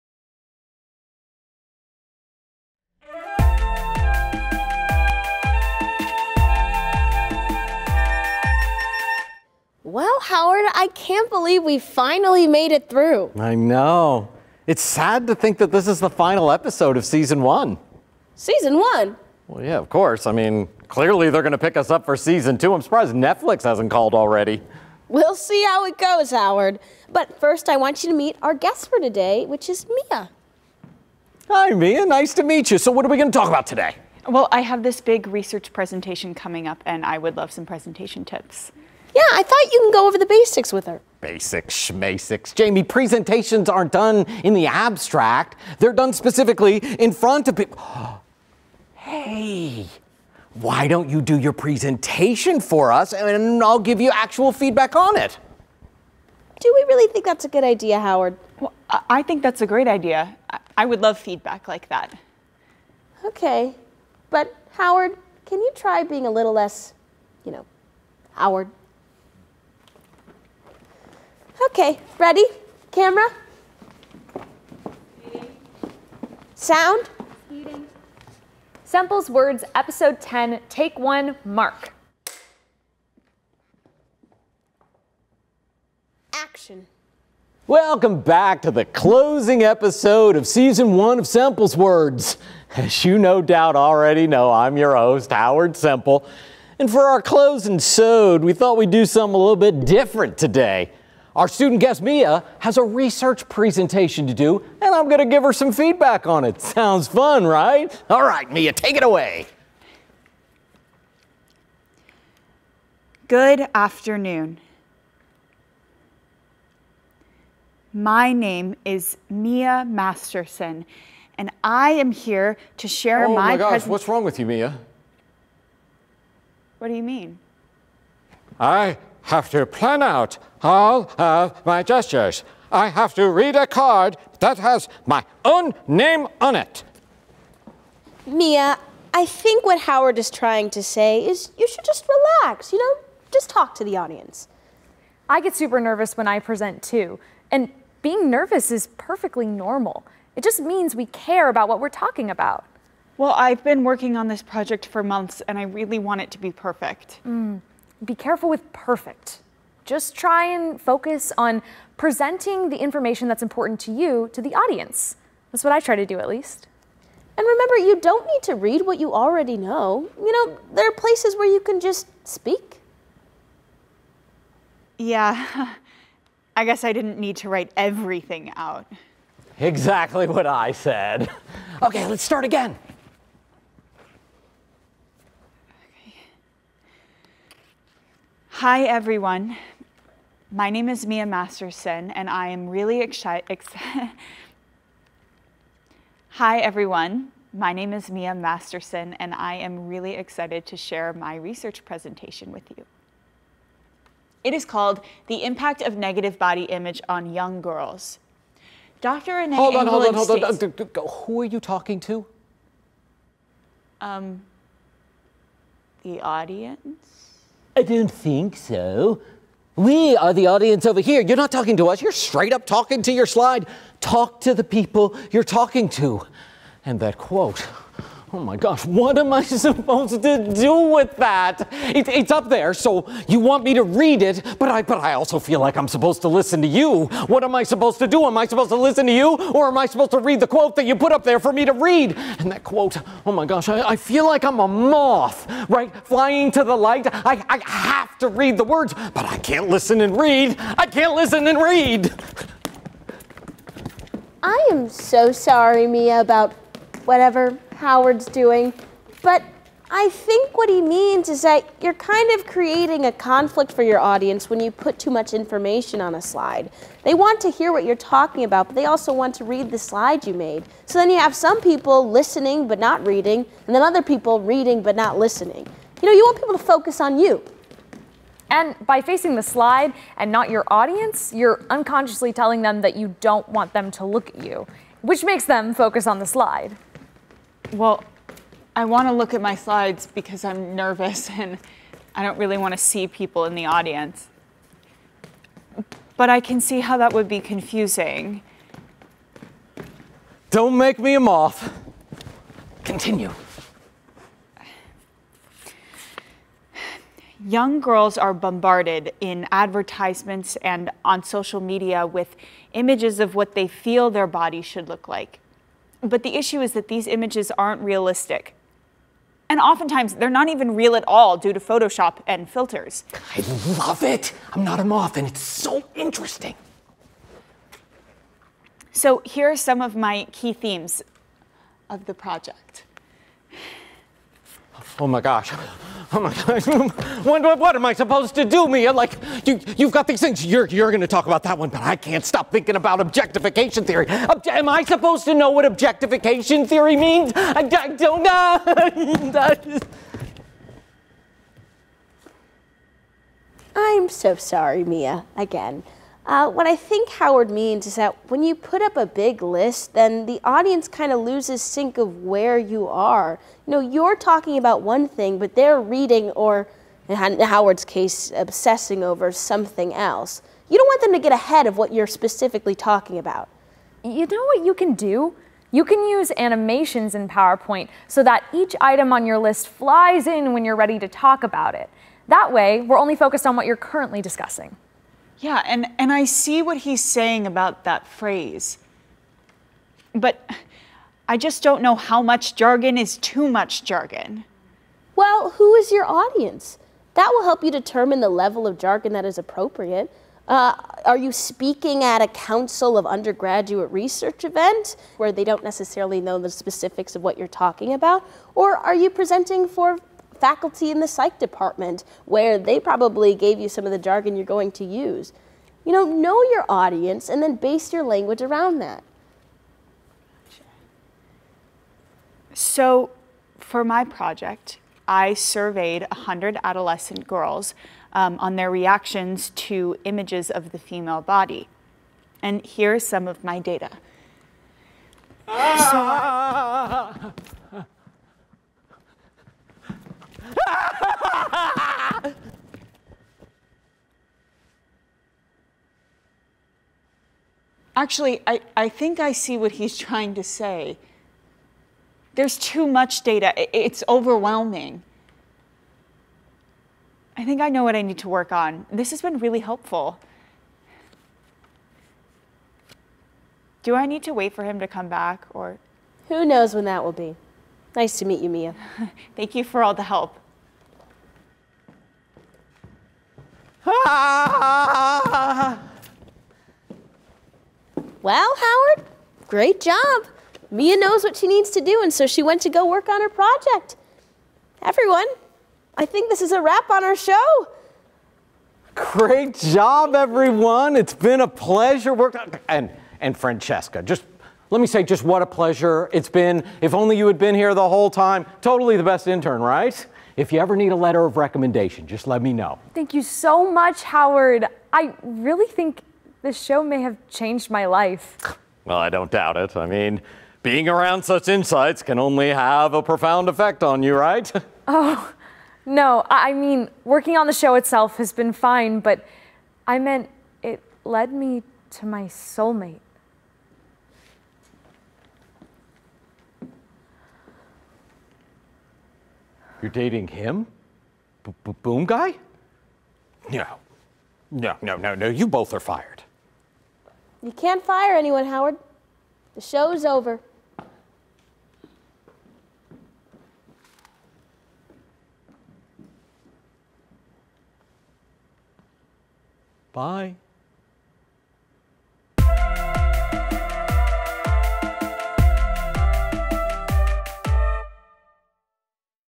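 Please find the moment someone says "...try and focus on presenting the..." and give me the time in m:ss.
2:40.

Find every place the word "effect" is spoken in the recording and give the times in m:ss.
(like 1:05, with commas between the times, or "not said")
8:33.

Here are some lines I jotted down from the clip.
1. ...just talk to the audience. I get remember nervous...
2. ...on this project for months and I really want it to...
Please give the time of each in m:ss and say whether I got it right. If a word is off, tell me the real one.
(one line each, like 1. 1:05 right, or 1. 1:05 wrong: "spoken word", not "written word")
1. 2:23 wrong: "super", not "remember"
2. 2:34 right.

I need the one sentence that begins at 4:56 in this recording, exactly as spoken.
But I can see how that would be confusing.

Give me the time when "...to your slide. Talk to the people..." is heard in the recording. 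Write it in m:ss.
3:43.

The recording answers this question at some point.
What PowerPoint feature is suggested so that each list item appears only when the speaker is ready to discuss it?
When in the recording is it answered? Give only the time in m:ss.
6:16.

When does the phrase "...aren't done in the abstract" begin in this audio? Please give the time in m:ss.
0:43.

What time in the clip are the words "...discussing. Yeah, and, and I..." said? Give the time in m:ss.
6:24.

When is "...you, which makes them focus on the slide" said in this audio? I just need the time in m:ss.
4:44.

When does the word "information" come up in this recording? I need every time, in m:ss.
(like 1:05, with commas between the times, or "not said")
2:42, 4:25.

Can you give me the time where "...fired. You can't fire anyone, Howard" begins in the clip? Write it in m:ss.
8:55.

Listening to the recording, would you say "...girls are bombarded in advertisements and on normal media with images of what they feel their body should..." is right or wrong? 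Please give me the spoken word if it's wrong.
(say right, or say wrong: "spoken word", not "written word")
wrong: "social", not "normal".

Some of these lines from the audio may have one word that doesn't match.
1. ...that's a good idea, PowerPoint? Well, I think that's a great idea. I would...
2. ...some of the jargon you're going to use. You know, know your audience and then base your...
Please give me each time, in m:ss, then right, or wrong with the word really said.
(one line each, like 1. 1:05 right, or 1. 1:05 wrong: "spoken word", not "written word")
1. 0:57 wrong: "Howard", not "PowerPoint"
2. 6:53 right.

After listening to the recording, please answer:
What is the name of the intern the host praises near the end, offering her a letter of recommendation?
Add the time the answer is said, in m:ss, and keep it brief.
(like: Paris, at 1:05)
Francesca, at 8:13.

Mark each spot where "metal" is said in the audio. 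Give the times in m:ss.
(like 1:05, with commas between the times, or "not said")
not said.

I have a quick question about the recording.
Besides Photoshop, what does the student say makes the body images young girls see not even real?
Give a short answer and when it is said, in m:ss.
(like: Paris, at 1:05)
filters, at 5:22.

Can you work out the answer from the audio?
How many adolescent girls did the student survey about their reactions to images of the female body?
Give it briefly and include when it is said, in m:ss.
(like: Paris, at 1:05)
100, at 7:06.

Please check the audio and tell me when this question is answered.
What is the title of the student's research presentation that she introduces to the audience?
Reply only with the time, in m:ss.
3:25.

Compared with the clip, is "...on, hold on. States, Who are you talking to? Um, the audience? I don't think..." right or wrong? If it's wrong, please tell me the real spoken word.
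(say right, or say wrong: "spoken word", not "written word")
right.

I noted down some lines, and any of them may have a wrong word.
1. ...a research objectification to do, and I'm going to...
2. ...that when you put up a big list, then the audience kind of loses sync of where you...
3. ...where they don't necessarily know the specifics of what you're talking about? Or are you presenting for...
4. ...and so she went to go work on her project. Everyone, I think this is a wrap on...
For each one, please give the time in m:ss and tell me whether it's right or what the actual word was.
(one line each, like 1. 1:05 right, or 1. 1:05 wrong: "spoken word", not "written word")
1. 1:42 wrong: "presentation", not "objectification"
2. 5:57 right
3. 6:45 right
4. 8:02 right.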